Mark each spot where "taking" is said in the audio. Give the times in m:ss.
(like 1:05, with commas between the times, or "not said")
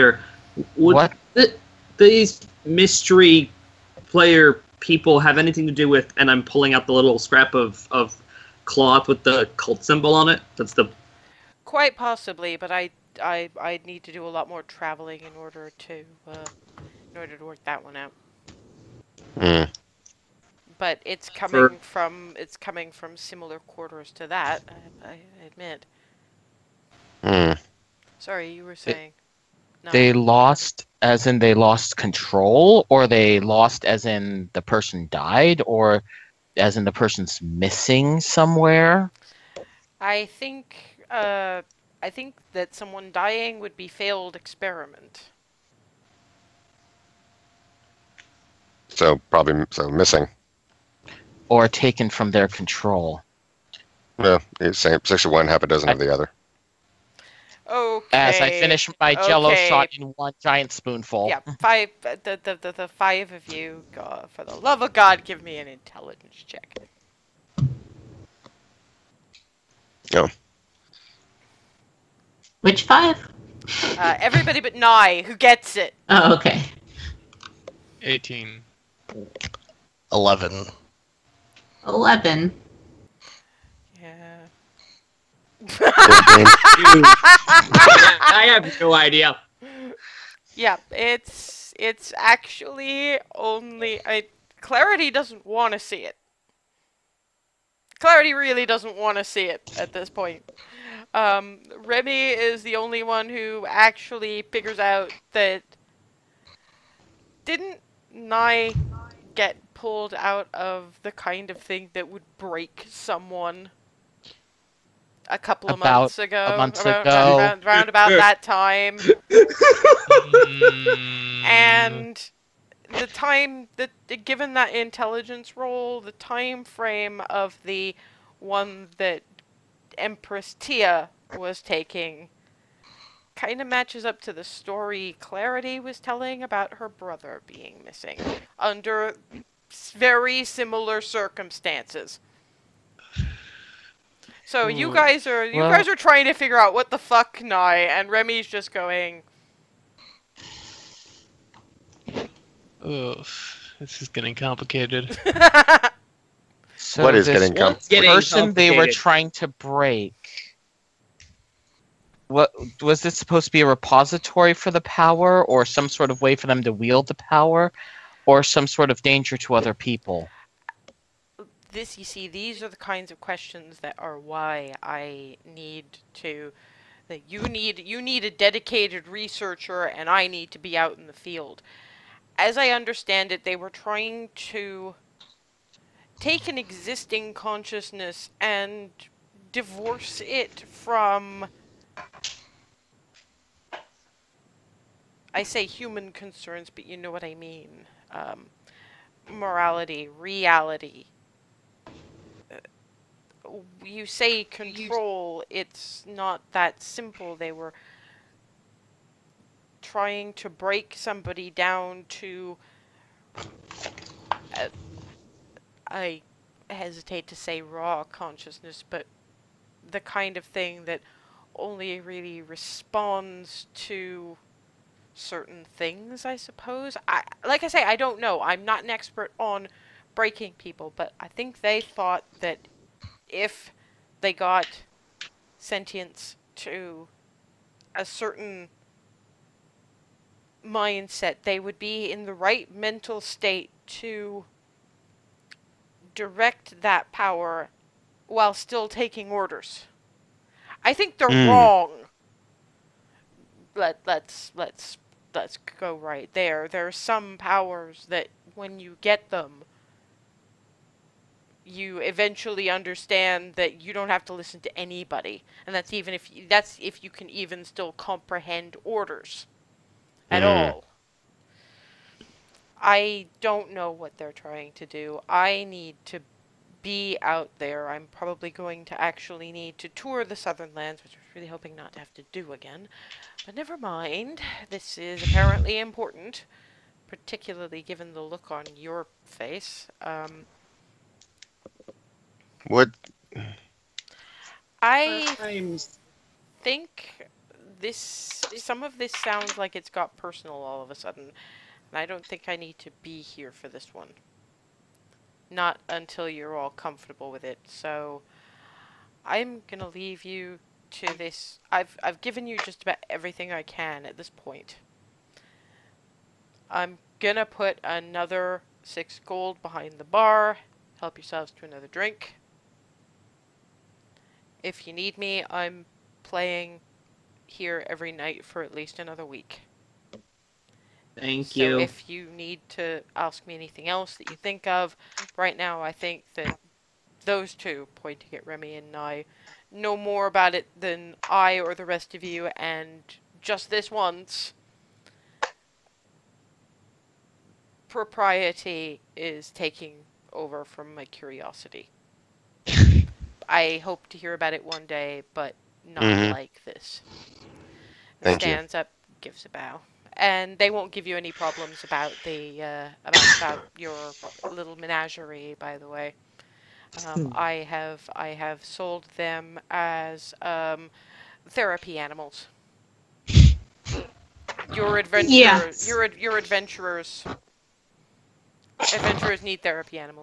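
2:11, 4:08, 5:49.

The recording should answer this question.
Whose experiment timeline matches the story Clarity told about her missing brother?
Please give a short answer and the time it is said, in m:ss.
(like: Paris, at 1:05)
Empress Tia, at 2:09.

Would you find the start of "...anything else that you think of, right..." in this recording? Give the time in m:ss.
5:33.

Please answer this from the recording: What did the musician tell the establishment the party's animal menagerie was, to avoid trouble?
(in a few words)
therapy animals.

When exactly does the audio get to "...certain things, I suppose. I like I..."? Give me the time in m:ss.
3:45.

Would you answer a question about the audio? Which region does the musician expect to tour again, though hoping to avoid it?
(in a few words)
Southern Lands.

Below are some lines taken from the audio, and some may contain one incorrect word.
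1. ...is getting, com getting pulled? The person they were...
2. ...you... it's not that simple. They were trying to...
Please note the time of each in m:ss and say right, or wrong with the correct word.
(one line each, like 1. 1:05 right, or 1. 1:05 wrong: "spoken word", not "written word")
1. 2:37 wrong: "complicated", not "pulled"
2. 3:25 right.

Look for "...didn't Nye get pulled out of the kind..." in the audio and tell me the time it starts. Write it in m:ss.
1:47.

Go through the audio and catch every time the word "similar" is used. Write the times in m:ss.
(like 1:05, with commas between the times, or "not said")
0:23, 2:20.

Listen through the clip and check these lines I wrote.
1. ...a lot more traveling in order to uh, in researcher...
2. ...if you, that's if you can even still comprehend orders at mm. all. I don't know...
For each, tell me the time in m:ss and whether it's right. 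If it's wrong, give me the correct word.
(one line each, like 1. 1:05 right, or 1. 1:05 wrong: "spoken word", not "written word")
1. 0:14 wrong: "order", not "researcher"
2. 4:26 right.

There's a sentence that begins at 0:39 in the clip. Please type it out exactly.
I think uh, I think that someone dying would be failed experiment.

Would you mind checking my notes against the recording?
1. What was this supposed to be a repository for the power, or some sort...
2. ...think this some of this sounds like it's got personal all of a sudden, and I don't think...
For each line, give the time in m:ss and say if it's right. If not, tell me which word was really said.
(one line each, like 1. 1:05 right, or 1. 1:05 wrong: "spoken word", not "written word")
1. 2:42 right
2. 4:56 right.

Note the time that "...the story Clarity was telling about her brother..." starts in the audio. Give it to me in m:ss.
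2:14.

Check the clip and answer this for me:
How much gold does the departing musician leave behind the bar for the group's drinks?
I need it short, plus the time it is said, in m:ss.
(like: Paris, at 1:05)
6 gold, at 5:18.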